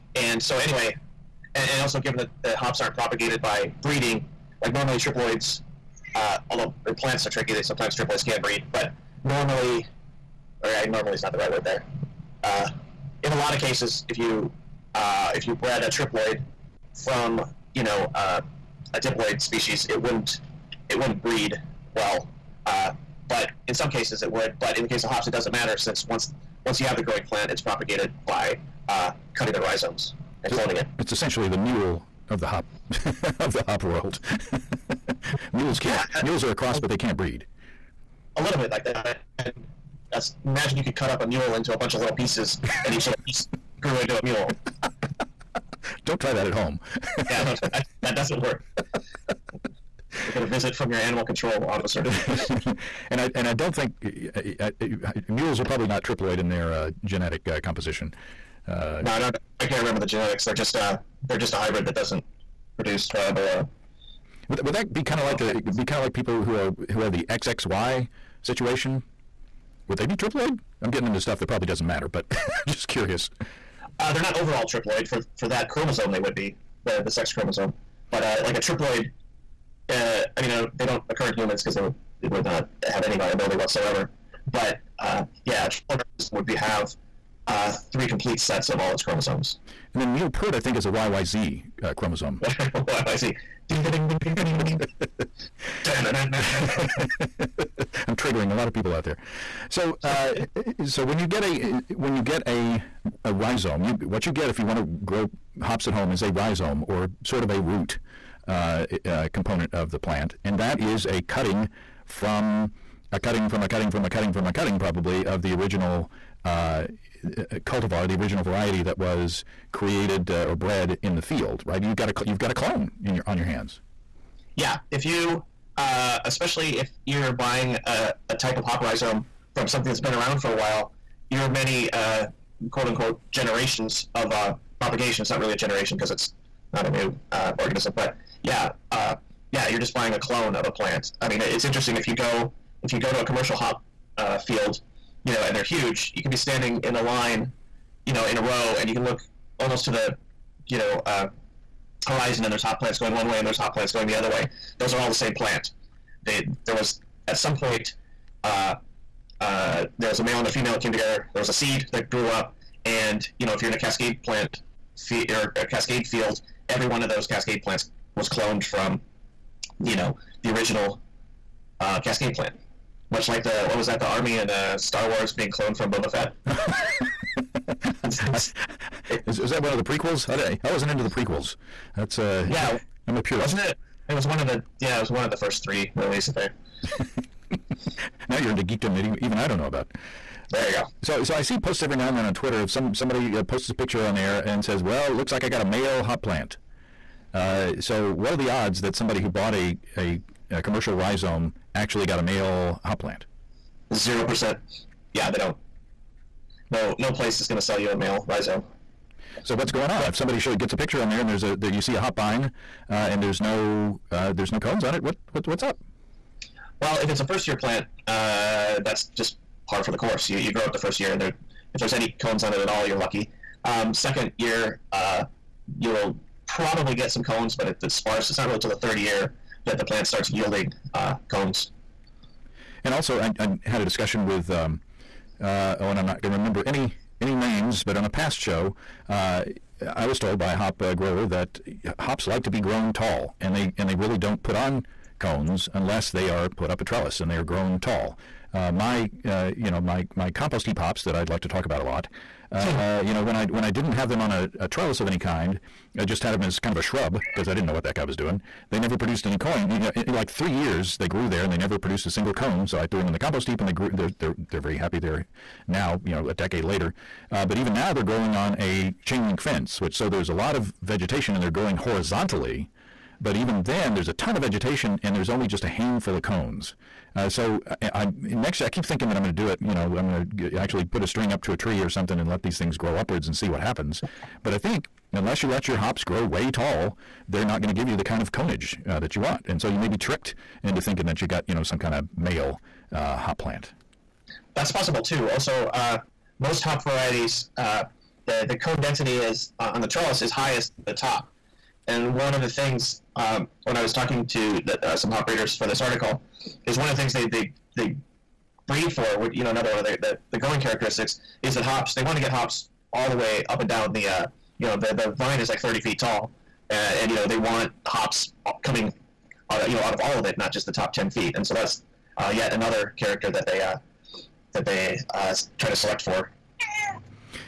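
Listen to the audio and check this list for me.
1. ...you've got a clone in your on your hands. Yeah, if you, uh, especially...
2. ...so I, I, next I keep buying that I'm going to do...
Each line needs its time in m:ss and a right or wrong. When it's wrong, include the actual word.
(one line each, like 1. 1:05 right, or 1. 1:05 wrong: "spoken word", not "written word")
1. 2:02 right
2. 4:37 wrong: "thinking", not "buying".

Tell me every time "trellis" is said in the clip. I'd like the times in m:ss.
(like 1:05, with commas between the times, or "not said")
4:06, 4:14, 4:59.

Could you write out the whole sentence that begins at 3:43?
Um, second year, uh, you'll probably get some cones, but it, it's sparse.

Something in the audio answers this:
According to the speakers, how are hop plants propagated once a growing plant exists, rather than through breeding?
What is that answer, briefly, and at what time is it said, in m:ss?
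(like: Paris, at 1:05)
Cutting the rhizomes, at 0:29.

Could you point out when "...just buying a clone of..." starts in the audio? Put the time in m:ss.
2:19.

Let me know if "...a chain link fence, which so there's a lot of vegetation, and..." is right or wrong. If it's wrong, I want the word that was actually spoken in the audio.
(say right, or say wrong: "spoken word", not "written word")
right.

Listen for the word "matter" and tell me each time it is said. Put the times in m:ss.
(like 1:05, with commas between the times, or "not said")
0:25, 1:11.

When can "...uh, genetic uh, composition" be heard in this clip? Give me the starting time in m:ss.
0:56.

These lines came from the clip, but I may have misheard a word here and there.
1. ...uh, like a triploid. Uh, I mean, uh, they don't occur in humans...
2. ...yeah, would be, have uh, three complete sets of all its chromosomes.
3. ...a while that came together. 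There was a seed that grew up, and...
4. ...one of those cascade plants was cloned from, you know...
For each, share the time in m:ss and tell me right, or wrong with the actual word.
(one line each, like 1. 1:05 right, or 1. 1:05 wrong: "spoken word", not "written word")
1. 1:18 right
2. 1:25 right
3. 2:40 wrong: "female", not "while"
4. 2:46 right.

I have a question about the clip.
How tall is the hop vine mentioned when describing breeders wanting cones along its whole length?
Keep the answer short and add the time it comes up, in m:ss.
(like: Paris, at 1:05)
30 feet, at 5:15.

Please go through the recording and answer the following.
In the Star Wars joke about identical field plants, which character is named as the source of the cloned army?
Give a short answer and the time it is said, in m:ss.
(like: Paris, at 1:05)
Boba Fett, at 2:55.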